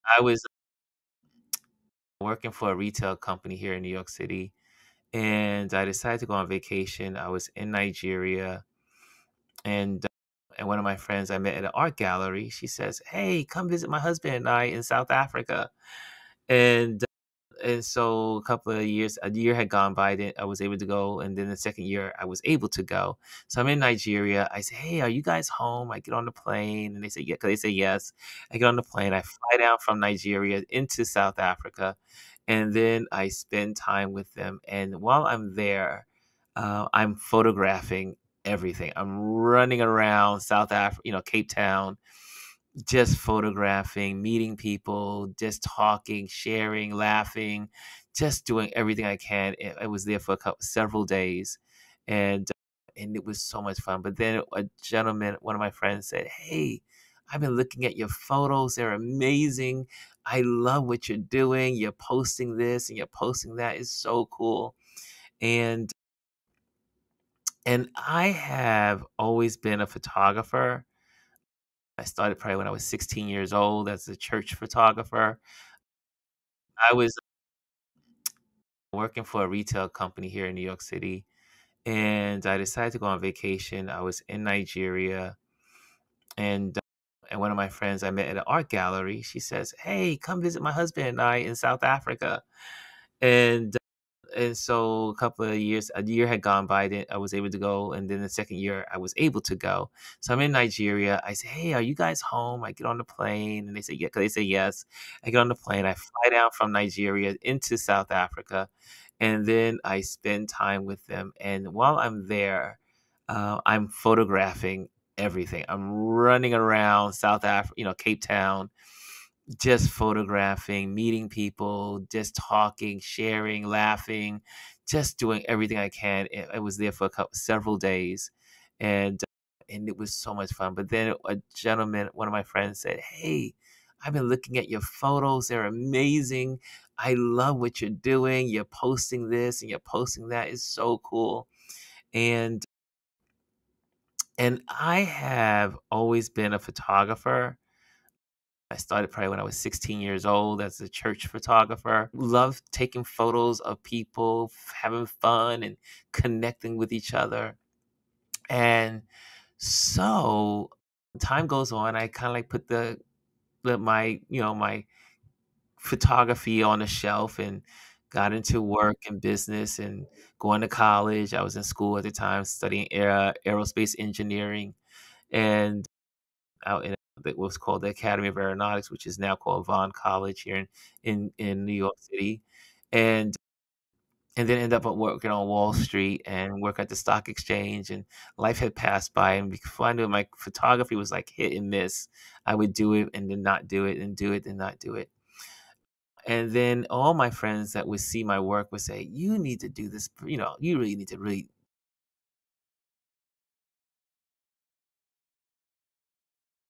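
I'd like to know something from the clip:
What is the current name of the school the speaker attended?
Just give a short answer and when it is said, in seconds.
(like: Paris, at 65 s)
Vaughn College, at 179 s.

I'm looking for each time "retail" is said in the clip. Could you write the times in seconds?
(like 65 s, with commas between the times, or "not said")
2 s, 79 s.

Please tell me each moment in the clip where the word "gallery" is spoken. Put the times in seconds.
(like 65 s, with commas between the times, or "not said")
11 s, 88 s.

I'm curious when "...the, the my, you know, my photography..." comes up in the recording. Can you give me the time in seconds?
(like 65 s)
162 s.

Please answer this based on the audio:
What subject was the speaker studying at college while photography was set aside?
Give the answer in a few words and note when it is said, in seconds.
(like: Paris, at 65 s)
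Aerospace engineering, at 173 s.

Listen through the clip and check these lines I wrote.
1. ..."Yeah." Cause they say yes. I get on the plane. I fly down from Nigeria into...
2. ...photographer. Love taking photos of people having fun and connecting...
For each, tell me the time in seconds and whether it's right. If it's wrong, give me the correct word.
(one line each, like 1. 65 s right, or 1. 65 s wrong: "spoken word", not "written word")
1. 103 s right
2. 151 s right.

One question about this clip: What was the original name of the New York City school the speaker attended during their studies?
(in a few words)
Academy of Aeronautics.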